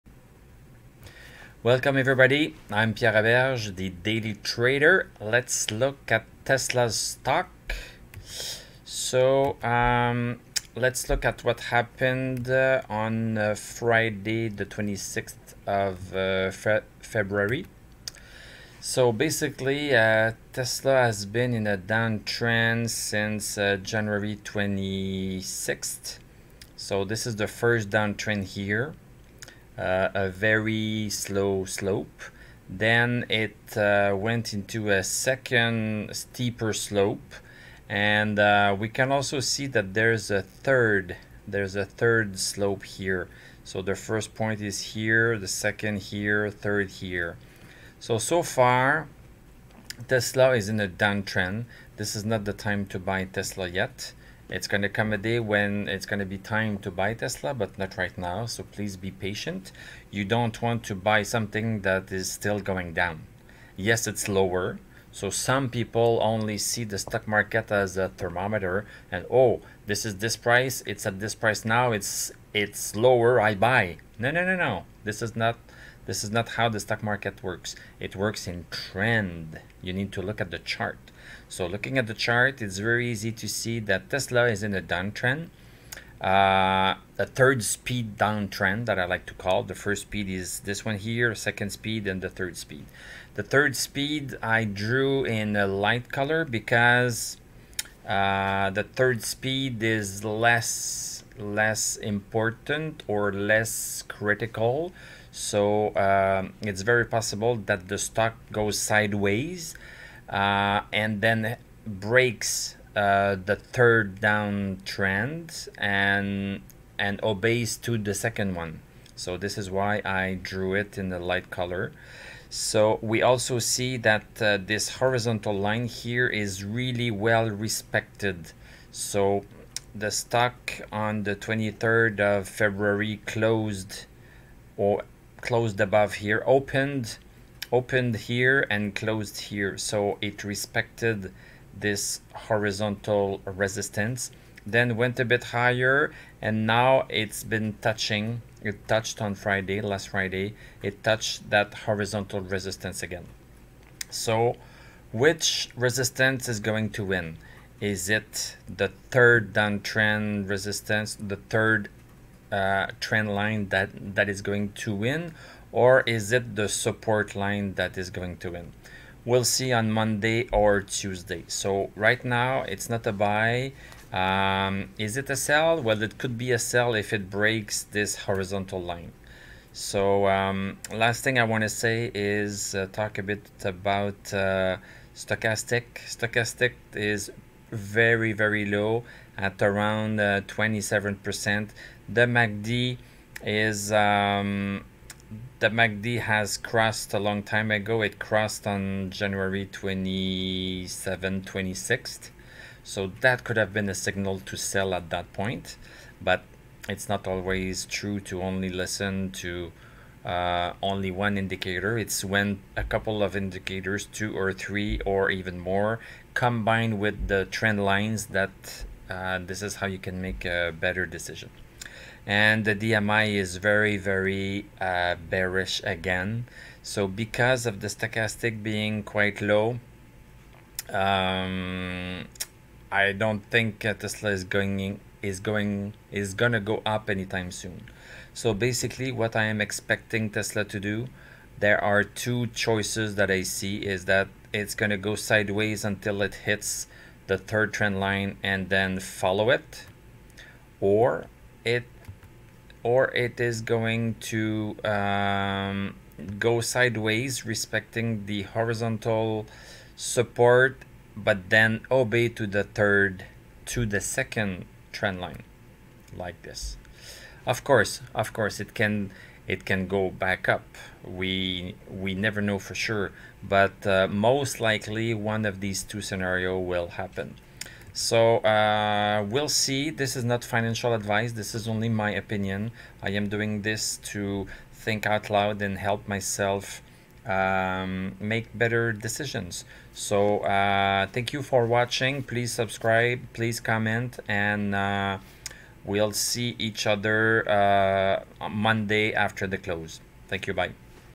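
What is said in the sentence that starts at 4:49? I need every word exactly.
So uh, thank you for watching.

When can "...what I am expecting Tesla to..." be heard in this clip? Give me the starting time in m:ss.
3:59.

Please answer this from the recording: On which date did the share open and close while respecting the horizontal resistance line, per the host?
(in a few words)
23rd of February.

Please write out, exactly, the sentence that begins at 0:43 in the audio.
So the first point is here, the second here, third here.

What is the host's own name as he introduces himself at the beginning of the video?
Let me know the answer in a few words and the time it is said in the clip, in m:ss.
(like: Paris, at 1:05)
Pierre Aberge, at 0:02.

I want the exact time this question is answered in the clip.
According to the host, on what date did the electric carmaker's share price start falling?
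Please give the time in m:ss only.
0:23.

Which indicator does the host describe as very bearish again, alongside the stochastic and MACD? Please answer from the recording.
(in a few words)
DMI.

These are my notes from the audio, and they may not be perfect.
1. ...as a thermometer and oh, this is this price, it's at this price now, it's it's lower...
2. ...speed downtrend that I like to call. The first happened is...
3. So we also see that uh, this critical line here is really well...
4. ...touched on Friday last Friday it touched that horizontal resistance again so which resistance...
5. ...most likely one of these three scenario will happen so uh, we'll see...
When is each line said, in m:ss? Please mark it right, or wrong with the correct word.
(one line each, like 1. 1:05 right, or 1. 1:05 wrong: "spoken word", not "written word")
1. 1:07 right
2. 1:27 wrong: "speed", not "happened"
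3. 2:02 wrong: "horizontal", not "critical"
4. 2:28 right
5. 4:34 wrong: "two", not "three".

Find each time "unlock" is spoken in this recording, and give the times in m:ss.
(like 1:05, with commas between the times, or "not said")
not said.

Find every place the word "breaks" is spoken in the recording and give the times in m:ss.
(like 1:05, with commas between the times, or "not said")
1:51, 2:57.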